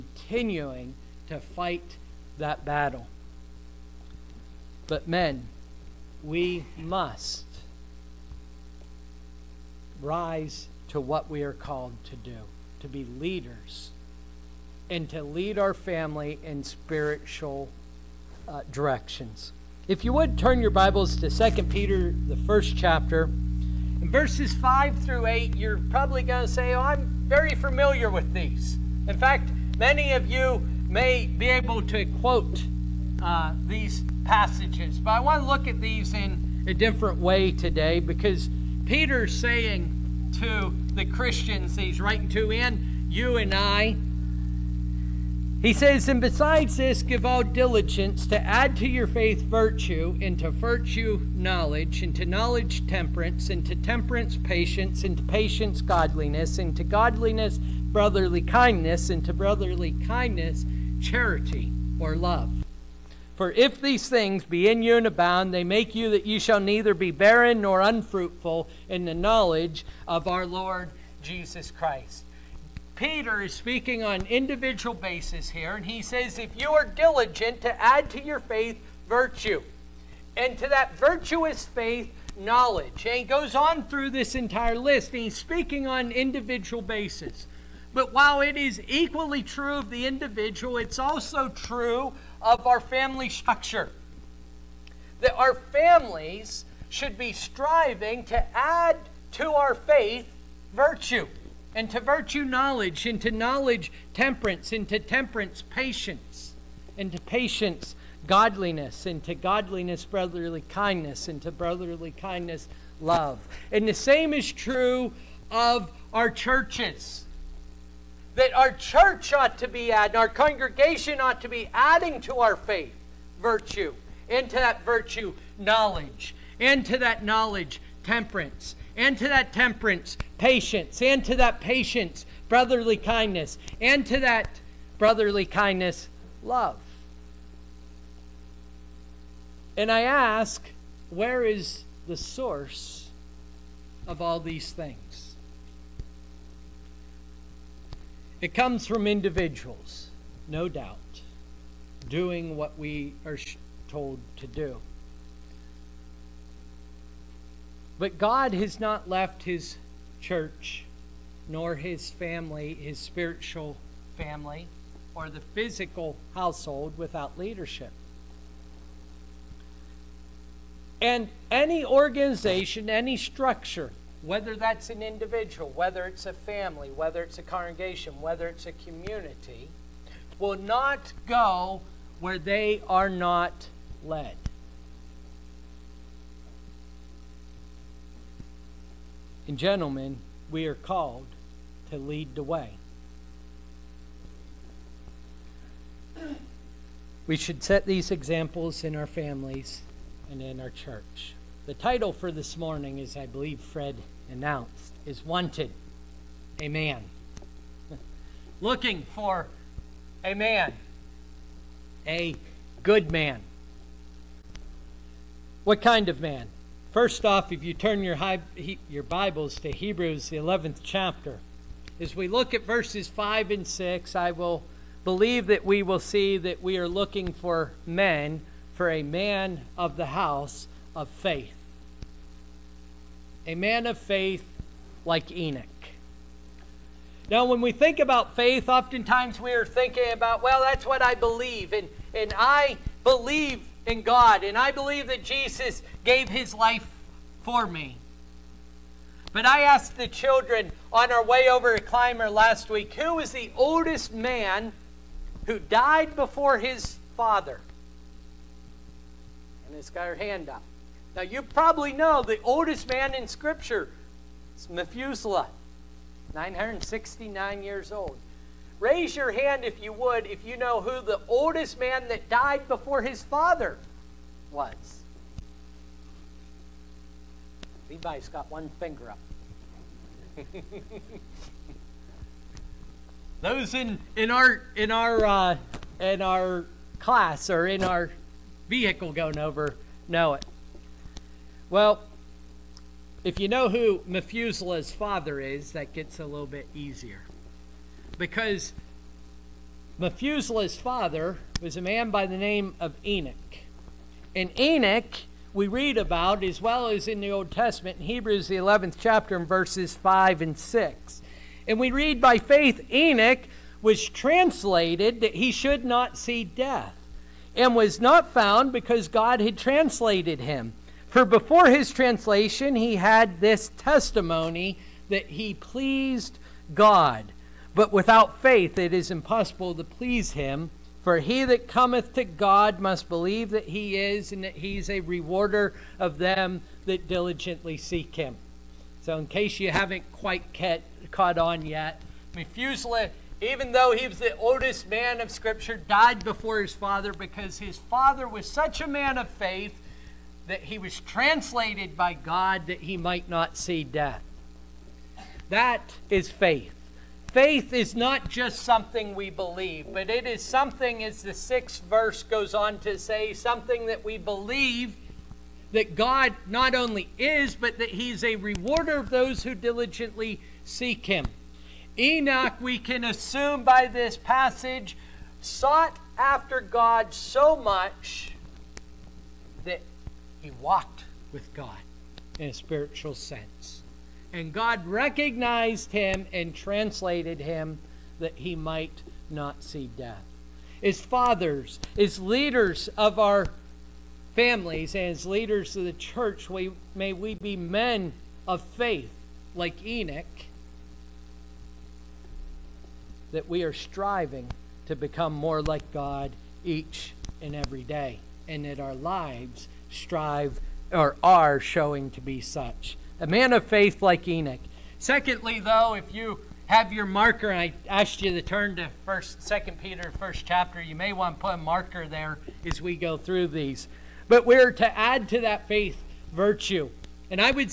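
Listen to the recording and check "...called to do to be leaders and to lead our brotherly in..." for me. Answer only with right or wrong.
wrong.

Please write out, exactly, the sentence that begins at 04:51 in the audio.
Well, if you know who Methuselah's father is, that gets a little bit easier.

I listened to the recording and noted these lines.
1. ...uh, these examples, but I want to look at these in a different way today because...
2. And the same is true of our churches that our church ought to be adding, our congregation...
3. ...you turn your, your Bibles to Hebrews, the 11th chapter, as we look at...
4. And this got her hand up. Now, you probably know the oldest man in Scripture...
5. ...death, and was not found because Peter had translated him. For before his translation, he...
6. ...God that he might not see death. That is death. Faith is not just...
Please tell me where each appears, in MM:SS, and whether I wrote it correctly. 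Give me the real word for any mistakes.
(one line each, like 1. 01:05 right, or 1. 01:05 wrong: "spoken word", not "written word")
1. 00:33 wrong: "passages", not "examples"
2. 01:53 right
3. 03:37 right
4. 04:19 right
5. 05:16 wrong: "God", not "Peter"
6. 05:52 wrong: "faith", not "death".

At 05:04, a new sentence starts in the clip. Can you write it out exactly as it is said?
And Enoch, we read about as well as in the Old Testament, in Hebrews, the 11th chapter, in verses 5 and 6.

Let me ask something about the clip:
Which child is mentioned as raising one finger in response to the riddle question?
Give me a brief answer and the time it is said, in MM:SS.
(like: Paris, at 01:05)
Levi, at 04:37.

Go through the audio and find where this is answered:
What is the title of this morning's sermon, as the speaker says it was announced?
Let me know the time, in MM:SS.
03:25.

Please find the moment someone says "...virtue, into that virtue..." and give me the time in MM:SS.
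02:03.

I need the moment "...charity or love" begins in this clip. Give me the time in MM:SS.
01:00.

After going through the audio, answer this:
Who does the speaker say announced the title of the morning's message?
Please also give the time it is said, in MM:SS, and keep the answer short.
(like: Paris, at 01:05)
Fred, at 03:23.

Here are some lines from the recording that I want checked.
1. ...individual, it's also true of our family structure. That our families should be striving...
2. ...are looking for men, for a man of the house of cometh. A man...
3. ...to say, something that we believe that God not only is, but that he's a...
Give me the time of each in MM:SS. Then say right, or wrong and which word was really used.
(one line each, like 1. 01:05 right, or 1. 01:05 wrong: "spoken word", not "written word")
1. 01:30 right
2. 03:46 wrong: "faith", not "cometh"
3. 06:02 right.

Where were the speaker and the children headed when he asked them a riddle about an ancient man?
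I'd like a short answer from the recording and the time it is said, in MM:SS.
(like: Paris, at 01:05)
Clymer, at 04:11.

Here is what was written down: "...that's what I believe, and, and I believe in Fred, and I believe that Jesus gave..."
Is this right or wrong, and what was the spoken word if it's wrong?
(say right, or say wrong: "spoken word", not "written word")
wrong: "God", not "Fred".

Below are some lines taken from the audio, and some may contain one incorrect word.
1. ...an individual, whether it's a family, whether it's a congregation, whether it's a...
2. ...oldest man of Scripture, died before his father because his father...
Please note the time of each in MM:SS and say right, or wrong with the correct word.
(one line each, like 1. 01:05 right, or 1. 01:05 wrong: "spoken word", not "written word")
1. 02:54 right
2. 05:44 right.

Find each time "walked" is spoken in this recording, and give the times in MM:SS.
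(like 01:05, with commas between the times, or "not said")
06:20.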